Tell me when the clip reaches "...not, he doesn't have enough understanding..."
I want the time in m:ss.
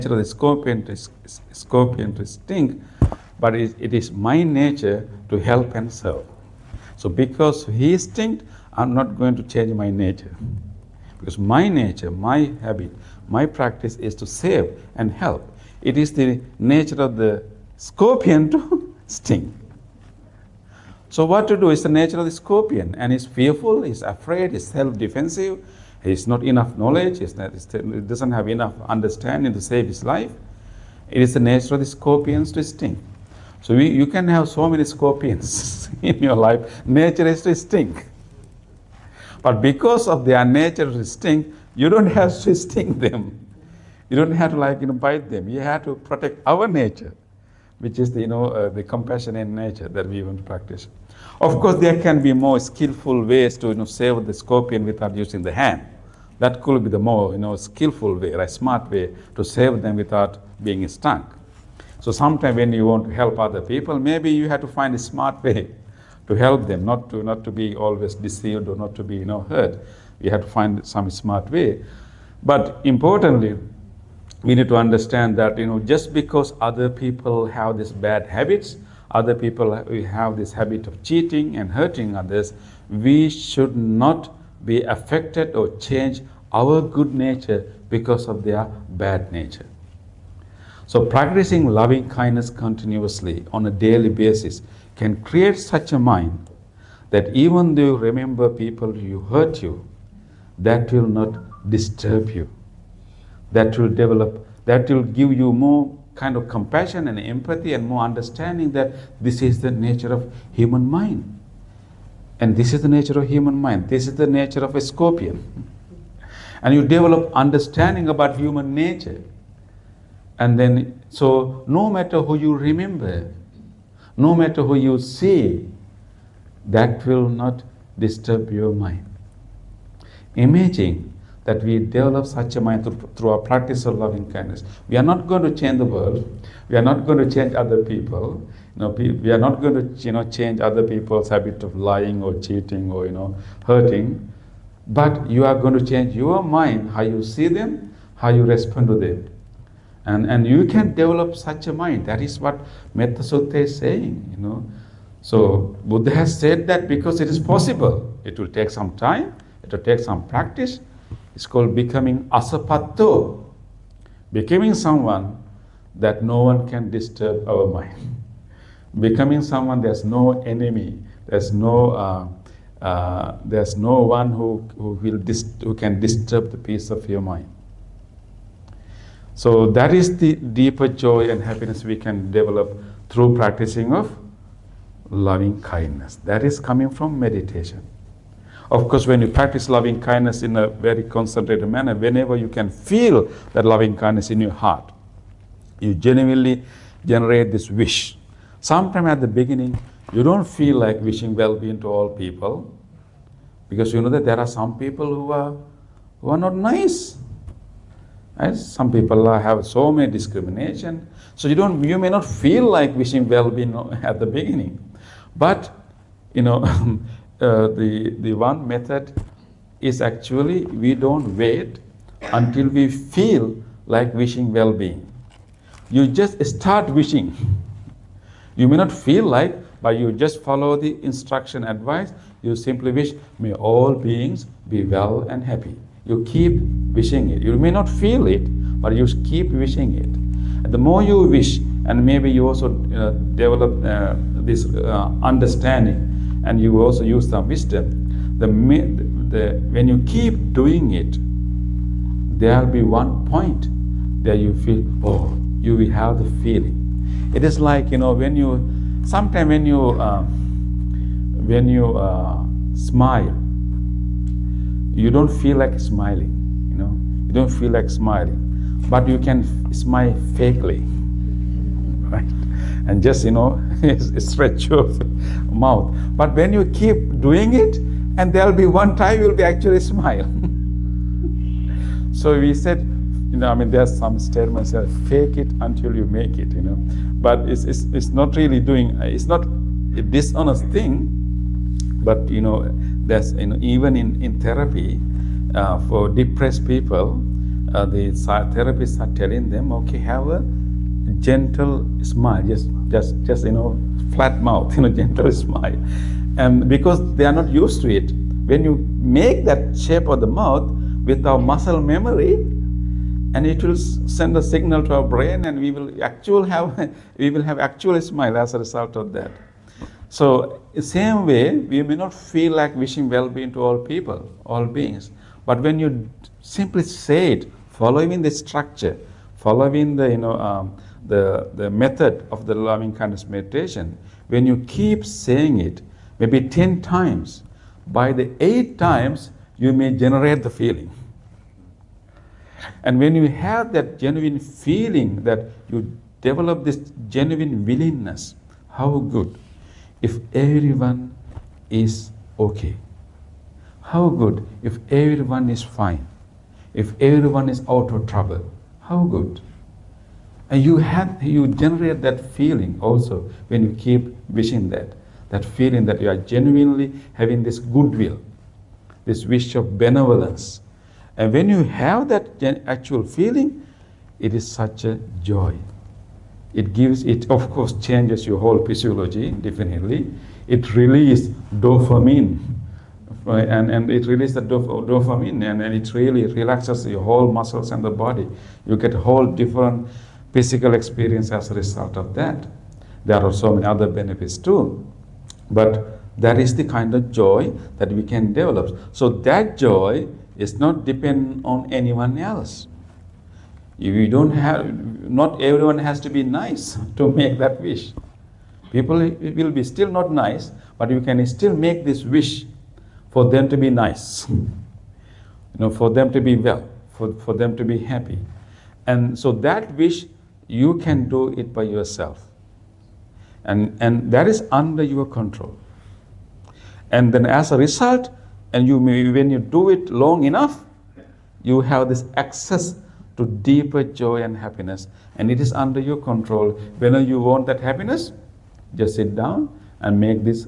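0:27.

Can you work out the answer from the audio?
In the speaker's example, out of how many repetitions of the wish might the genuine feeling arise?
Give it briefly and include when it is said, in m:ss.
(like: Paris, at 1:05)
10, at 5:36.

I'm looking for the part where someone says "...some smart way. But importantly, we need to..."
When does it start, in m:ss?
1:10.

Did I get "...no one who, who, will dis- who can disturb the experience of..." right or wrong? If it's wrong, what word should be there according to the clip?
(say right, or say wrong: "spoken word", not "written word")
wrong: "peace", not "experience".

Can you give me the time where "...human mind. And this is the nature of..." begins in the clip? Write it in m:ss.
1:50.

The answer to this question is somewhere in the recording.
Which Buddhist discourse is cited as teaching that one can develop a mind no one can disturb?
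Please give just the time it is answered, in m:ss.
2:32.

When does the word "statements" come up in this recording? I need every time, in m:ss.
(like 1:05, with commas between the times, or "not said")
4:44.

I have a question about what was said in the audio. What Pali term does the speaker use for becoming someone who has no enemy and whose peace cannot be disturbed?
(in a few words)
Asapatto.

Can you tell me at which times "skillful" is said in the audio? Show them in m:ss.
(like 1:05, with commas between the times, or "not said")
0:52, 0:57.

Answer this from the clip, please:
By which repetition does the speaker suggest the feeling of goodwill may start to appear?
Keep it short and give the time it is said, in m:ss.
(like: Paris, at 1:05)
8, at 5:38.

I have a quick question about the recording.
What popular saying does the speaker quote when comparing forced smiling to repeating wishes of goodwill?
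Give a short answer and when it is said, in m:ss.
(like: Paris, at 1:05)
Fake it until you make it, at 4:44.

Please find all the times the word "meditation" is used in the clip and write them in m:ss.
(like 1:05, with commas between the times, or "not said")
3:07, 5:33.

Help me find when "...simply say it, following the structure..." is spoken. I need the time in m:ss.
5:26.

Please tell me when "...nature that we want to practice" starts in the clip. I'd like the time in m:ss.
0:49.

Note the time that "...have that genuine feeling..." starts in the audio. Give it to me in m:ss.
5:43.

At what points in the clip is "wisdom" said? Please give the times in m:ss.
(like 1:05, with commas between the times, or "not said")
4:07.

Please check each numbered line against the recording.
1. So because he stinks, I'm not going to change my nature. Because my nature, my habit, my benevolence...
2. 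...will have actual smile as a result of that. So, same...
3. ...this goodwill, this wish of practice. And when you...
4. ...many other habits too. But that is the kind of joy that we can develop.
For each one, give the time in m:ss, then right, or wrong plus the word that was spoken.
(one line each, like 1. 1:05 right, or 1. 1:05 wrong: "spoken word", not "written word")
1. 0:06 wrong: "practice", not "benevolence"
2. 5:17 right
3. 6:07 wrong: "benevolence", not "practice"
4. 6:33 wrong: "benefits", not "habits".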